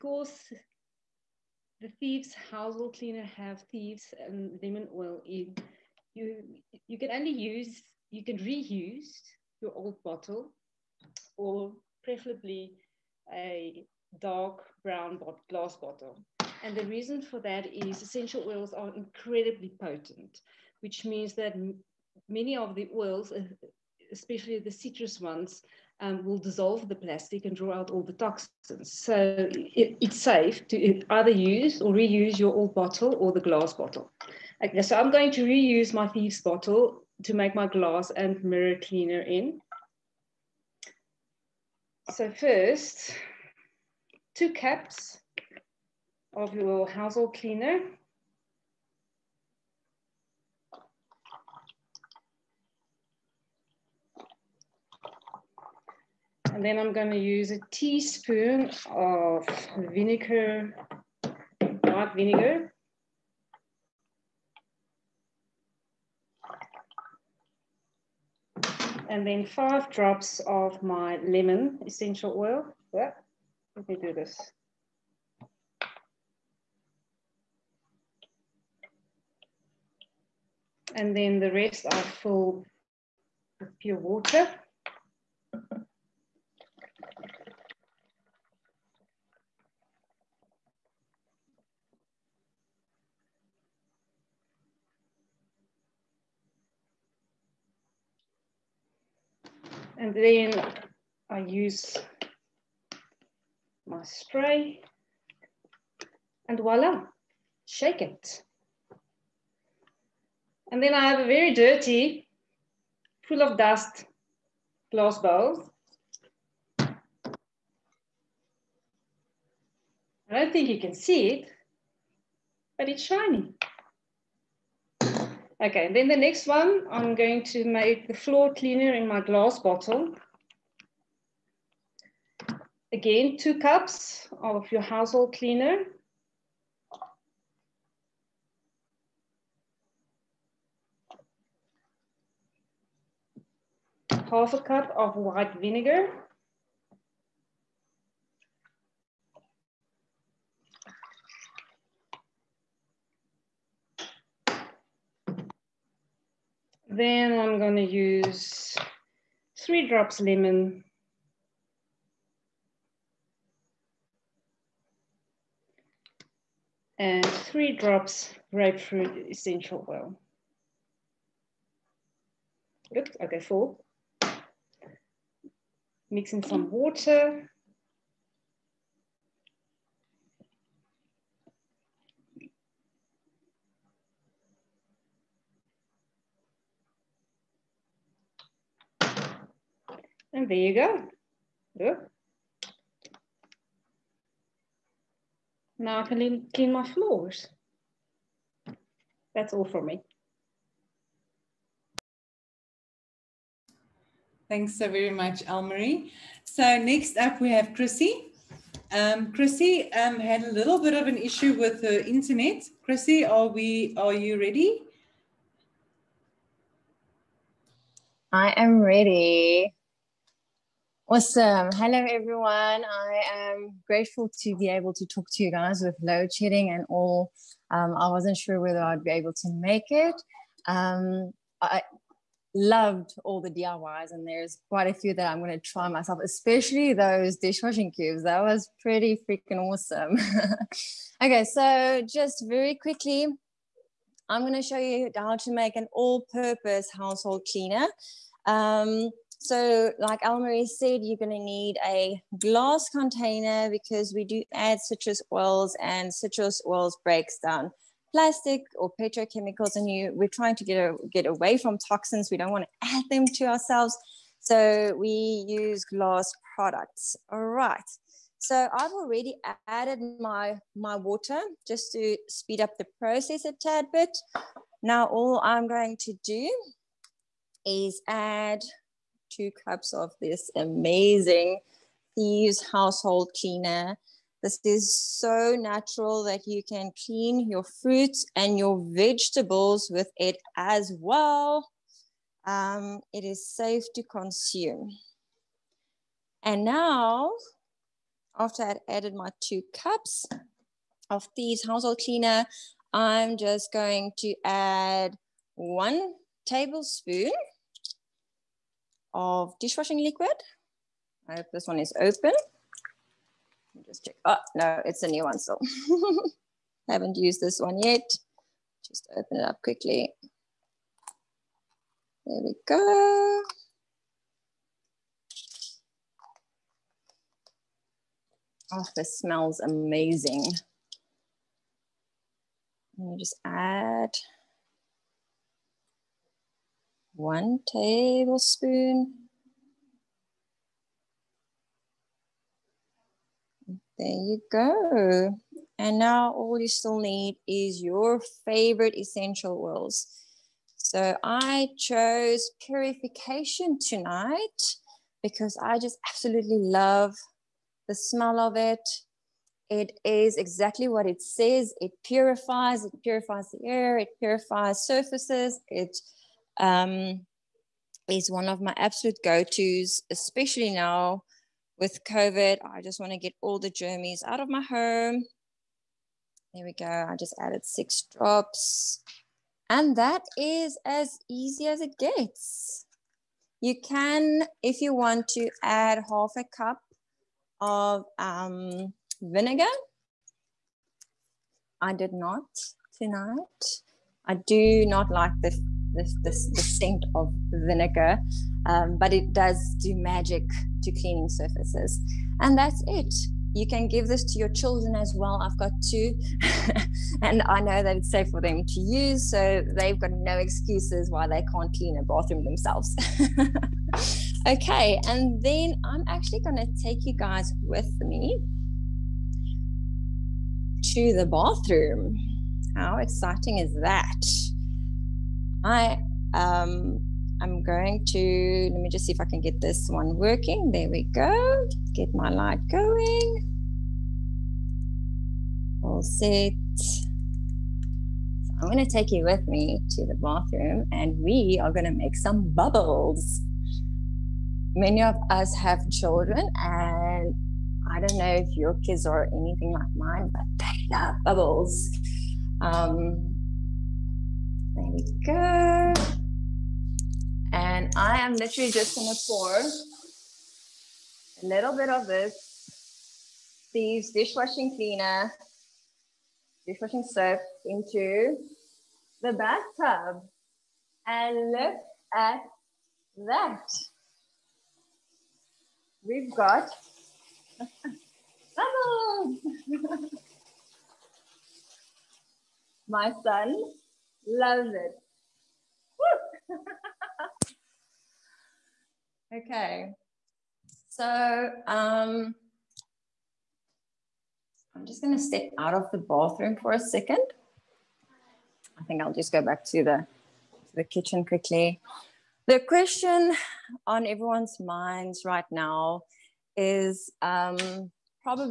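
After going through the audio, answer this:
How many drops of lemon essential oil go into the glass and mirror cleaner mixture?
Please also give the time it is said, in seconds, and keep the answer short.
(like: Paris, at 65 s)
5, at 69 s.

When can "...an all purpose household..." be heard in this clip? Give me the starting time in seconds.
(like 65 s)
245 s.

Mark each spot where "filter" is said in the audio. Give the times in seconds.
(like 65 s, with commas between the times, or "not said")
not said.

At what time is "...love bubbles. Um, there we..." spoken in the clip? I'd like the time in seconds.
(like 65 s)
450 s.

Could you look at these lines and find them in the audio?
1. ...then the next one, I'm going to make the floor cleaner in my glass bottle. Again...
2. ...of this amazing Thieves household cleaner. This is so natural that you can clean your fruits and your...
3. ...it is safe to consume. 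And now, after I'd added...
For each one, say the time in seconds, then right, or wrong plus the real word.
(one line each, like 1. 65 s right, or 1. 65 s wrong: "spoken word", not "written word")
1. 125 s right
2. 279 s right
3. 293 s right.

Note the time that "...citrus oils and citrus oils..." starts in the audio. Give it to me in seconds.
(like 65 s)
254 s.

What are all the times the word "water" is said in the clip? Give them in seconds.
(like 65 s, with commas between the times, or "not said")
83 s, 176 s, 270 s.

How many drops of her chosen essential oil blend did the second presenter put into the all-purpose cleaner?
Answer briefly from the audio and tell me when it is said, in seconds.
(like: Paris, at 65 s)
6, at 377 s.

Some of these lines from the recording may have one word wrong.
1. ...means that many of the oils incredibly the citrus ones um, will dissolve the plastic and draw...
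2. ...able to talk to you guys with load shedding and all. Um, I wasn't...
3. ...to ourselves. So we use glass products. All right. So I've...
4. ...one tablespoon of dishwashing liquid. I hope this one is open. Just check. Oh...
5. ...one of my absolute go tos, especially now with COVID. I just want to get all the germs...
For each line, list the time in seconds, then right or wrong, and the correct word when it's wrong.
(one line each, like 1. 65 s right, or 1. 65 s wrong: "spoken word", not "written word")
1. 21 s wrong: "especially", not "incredibly"
2. 224 s right
3. 263 s right
4. 305 s right
5. 368 s right.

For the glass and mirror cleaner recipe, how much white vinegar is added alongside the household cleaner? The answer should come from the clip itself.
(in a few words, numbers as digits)
1 teaspoon.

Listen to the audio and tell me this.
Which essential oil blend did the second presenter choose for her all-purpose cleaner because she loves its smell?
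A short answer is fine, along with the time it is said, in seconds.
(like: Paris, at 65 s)
Purification, at 352 s.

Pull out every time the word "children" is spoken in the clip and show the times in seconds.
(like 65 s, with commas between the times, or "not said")
404 s, 445 s.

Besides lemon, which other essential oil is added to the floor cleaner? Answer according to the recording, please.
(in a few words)
Grapefruit.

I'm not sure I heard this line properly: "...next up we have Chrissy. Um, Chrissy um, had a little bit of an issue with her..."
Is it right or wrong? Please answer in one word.
right.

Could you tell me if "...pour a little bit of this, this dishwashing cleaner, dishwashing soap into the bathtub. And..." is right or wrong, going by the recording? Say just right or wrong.
right.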